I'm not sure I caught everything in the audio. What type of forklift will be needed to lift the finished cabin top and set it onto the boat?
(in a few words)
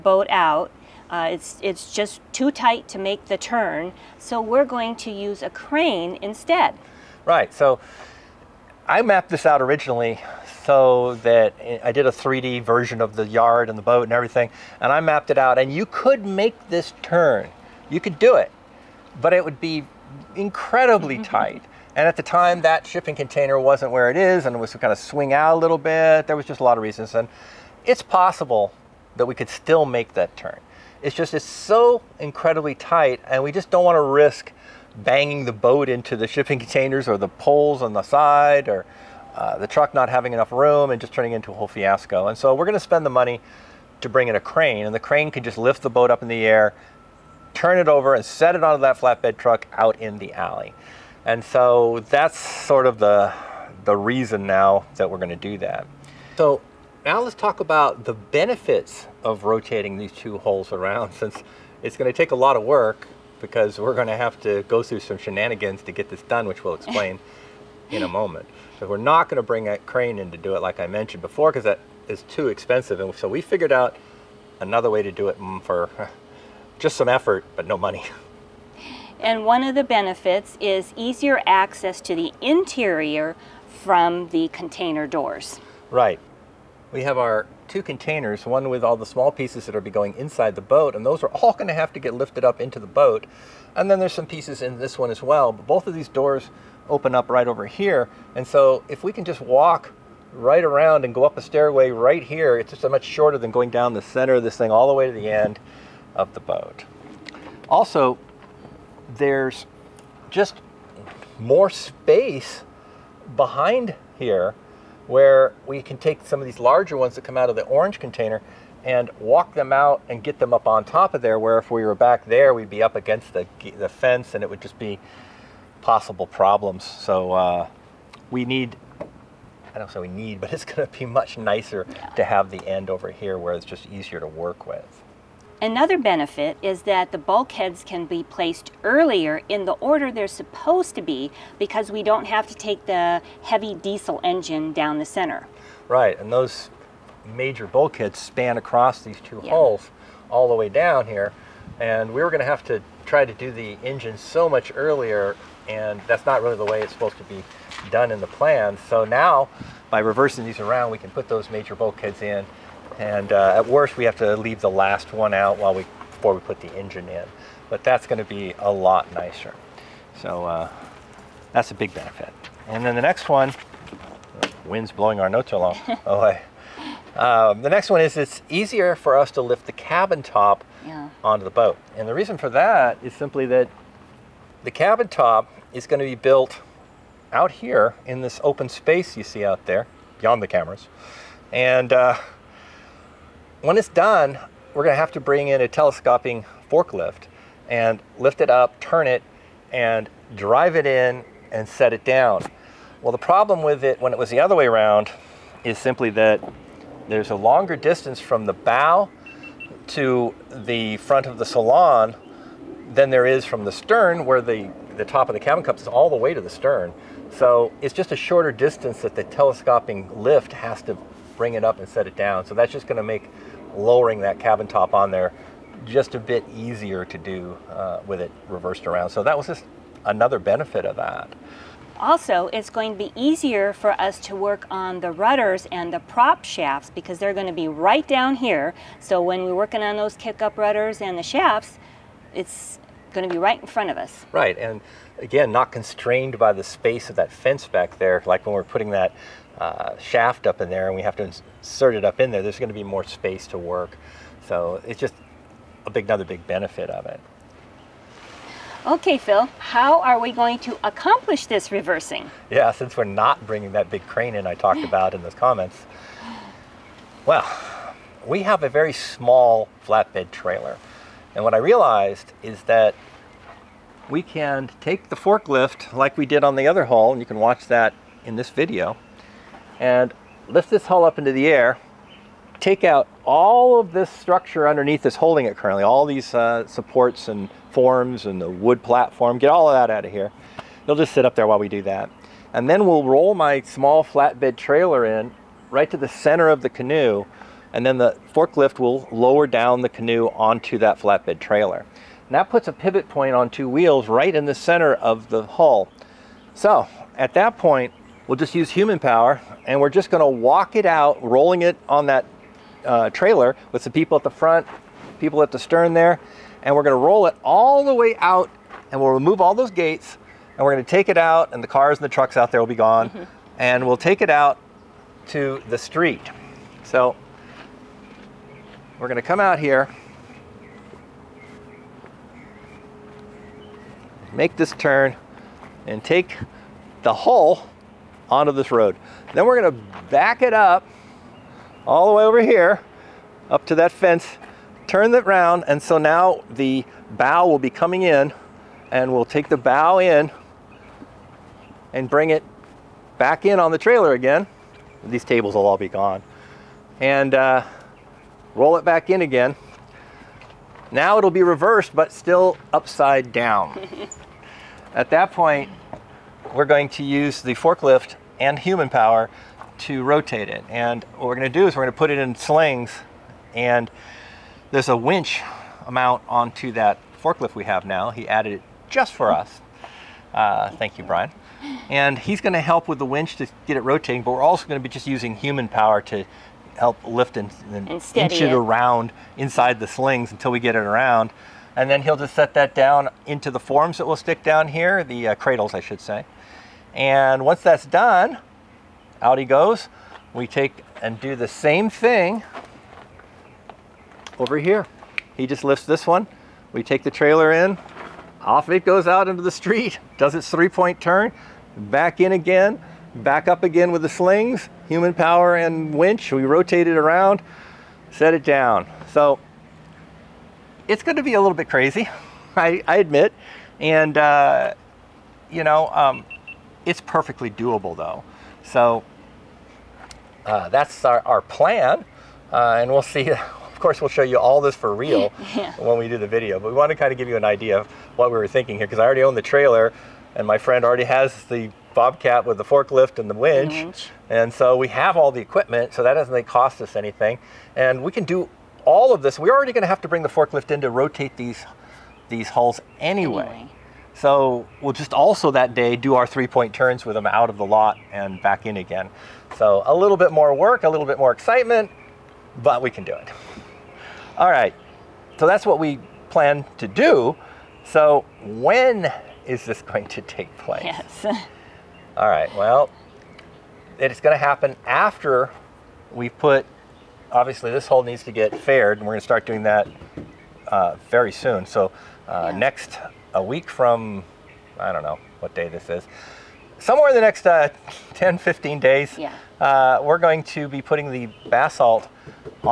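telescoping forklift.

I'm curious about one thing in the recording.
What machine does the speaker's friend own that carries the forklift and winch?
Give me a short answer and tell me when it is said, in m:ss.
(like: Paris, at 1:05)
Bobcat, at 7:21.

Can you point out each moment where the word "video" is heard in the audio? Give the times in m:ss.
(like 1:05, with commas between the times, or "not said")
4:38, 7:16.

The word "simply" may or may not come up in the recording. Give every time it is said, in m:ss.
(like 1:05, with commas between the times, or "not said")
3:03, 3:25.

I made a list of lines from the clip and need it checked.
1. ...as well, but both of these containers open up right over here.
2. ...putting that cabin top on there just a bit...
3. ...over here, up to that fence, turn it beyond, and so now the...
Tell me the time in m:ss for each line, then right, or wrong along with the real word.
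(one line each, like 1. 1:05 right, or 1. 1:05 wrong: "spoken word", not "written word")
1. 1:35 wrong: "doors", not "containers"
2. 3:43 wrong: "lowering", not "putting"
3. 5:42 wrong: "round", not "beyond".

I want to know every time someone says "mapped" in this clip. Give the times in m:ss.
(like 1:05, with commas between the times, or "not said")
0:09, 0:15.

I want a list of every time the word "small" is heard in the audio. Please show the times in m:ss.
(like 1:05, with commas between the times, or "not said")
1:29, 4:28, 4:53.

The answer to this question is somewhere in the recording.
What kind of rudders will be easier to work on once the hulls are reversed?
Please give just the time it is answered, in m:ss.
4:00.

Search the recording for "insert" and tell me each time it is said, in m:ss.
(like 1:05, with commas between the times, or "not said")
4:11.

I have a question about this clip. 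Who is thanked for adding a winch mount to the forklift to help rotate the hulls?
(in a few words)
Brian.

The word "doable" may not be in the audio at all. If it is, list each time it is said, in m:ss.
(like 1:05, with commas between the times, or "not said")
7:07.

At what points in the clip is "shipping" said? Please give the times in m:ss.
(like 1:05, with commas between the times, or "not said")
0:22, 0:36.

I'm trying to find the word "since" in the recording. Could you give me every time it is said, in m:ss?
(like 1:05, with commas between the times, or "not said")
1:01, 4:22.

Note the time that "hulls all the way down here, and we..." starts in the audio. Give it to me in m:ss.
2:29.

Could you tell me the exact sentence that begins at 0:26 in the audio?
There was just a lot of reasons.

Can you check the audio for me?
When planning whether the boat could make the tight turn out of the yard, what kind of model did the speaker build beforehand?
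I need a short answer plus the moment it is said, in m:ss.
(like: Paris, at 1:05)
3D version, at 0:12.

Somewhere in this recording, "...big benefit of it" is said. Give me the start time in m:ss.
4:16.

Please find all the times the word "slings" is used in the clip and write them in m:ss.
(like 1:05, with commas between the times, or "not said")
6:12, 6:29, 6:54.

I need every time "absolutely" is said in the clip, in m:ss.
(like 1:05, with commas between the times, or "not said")
not said.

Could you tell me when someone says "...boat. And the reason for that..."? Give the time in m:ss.
3:01.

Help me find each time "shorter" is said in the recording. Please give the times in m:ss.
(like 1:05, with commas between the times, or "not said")
1:43, 3:38.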